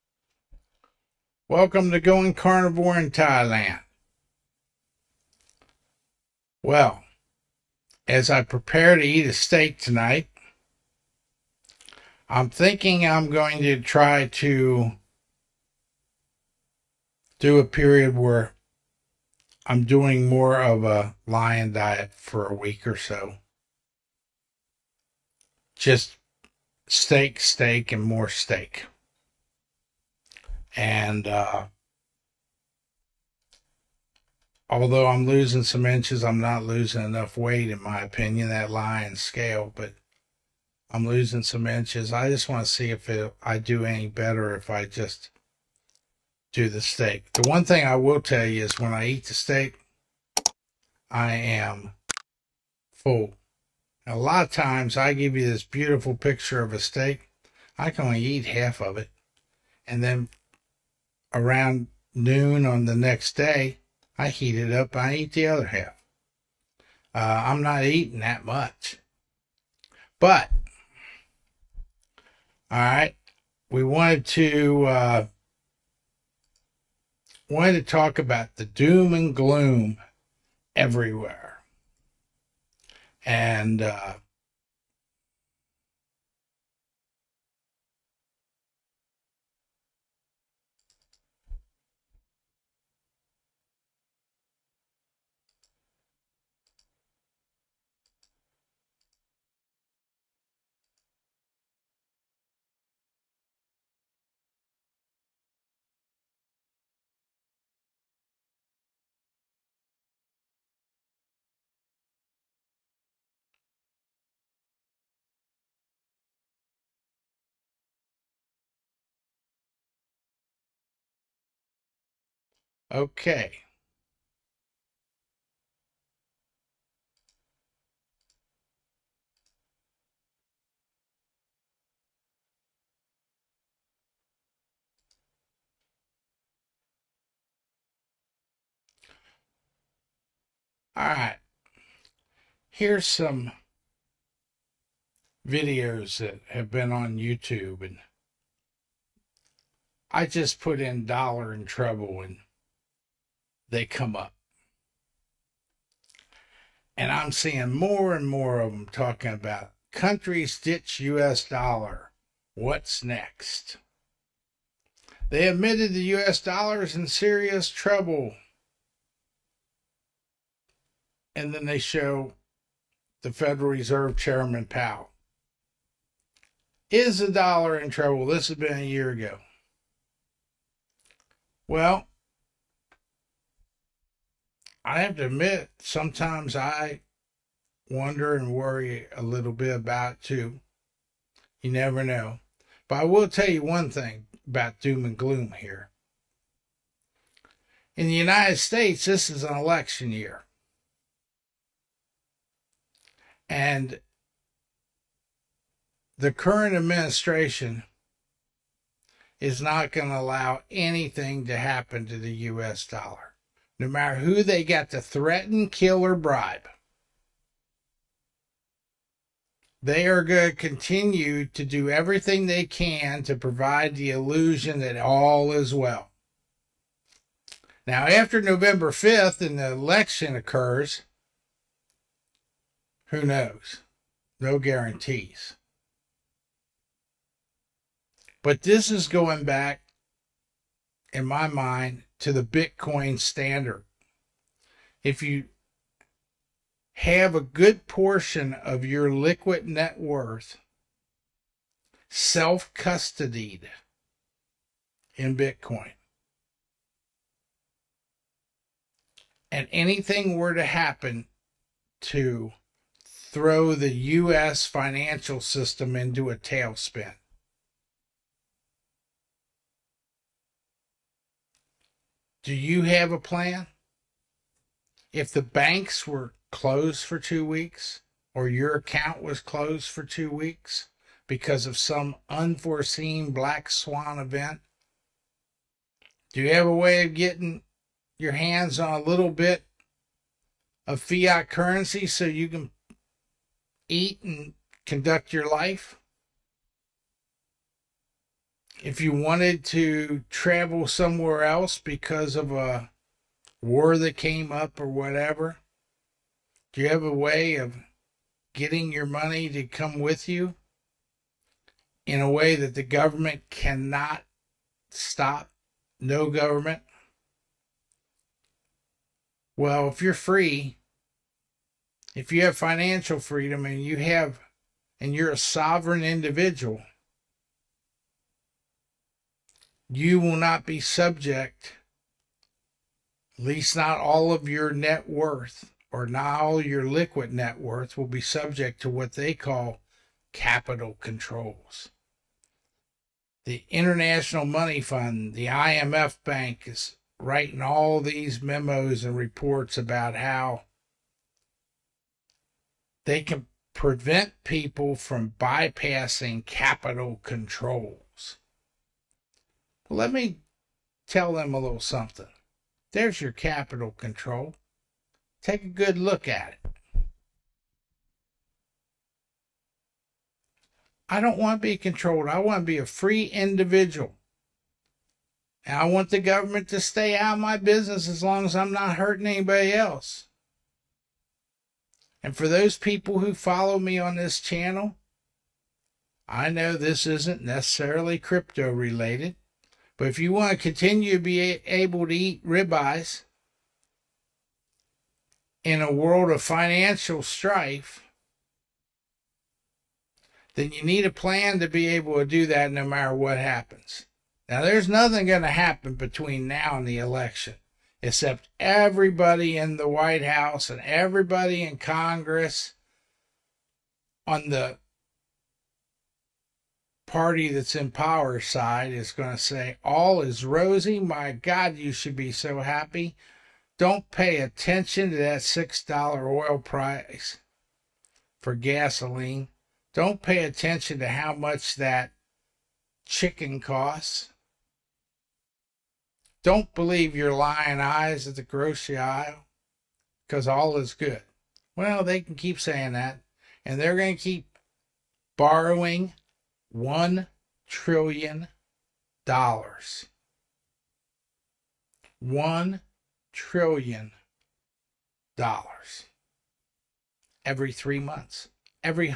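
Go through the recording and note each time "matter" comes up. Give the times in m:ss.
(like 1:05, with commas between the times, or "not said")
3:33, 6:42.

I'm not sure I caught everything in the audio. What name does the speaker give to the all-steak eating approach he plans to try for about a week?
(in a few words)
lion diet.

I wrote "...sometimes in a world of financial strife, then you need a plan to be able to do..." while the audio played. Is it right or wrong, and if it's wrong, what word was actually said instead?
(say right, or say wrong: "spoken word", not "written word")
wrong: "ribeyes", not "sometimes".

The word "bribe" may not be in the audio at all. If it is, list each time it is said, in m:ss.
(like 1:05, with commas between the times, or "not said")
3:36.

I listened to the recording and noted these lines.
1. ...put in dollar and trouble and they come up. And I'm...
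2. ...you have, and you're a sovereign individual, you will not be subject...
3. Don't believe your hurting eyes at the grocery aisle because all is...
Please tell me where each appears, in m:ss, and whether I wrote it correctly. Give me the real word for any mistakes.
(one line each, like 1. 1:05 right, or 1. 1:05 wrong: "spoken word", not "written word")
1. 2:30 right
2. 5:23 right
3. 7:16 wrong: "lying", not "hurting".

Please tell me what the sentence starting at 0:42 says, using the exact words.
I just want to see if it, I do any better if I just do the steak.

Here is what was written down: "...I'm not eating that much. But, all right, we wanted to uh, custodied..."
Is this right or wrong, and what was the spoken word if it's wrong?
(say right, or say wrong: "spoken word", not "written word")
wrong: "wanted", not "custodied".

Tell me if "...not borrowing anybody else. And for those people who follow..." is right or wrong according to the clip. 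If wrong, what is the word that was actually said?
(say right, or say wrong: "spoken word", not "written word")
wrong: "hurting", not "borrowing".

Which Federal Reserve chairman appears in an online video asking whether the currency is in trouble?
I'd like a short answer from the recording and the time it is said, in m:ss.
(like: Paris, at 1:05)
Powell, at 2:54.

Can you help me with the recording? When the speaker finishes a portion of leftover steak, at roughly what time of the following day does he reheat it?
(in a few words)
noon.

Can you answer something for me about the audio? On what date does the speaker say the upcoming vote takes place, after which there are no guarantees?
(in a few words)
November 5th.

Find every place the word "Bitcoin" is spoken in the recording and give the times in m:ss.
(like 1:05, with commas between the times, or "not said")
4:02, 4:15.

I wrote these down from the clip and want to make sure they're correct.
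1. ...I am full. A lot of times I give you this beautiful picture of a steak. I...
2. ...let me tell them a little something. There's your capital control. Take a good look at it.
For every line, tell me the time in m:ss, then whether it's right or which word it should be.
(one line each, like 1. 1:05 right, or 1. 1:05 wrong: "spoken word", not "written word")
1. 0:51 right
2. 5:59 right.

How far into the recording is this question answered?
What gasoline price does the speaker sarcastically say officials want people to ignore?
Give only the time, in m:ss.
7:05.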